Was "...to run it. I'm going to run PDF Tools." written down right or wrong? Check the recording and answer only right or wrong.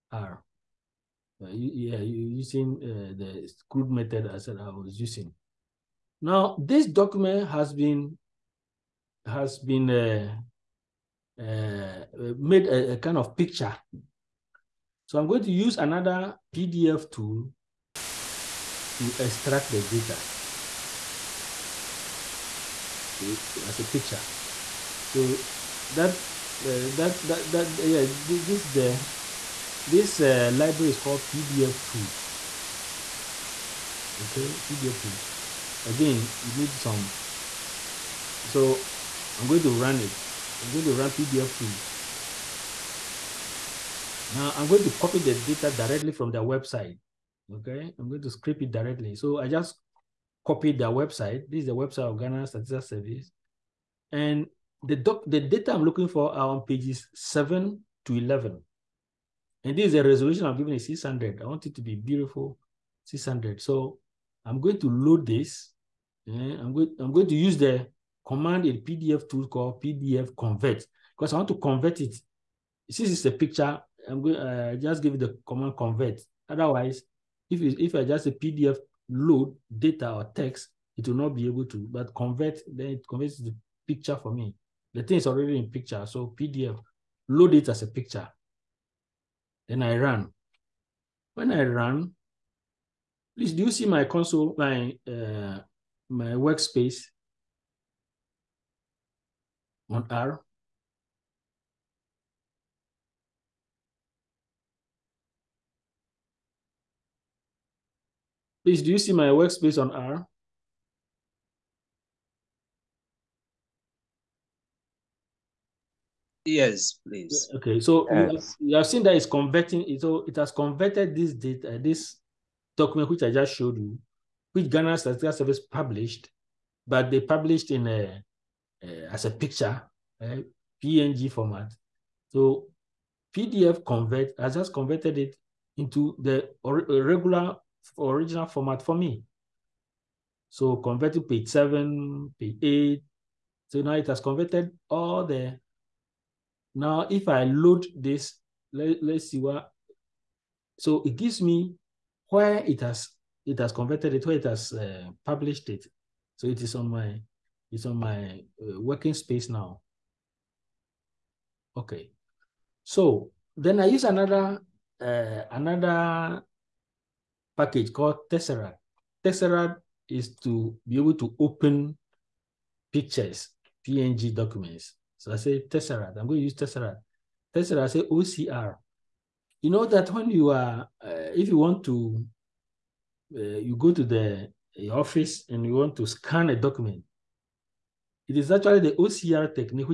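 right.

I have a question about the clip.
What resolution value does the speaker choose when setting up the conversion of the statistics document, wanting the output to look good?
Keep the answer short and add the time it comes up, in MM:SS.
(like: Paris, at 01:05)
600, at 01:01.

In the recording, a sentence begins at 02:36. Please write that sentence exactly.
So it is on my, it's on my uh, working space now.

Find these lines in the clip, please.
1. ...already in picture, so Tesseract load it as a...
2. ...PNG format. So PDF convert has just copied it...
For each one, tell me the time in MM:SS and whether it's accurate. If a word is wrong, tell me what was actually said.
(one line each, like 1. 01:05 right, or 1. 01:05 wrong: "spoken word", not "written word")
1. 01:25 wrong: "PDF", not "Tesseract"
2. 02:10 wrong: "converted", not "copied".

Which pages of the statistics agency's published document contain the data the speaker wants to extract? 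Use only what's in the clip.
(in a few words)
7 to 11.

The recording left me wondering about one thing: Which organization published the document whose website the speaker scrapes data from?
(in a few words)
Ghana Statistics Service.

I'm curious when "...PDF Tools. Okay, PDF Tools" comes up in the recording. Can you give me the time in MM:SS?
00:31.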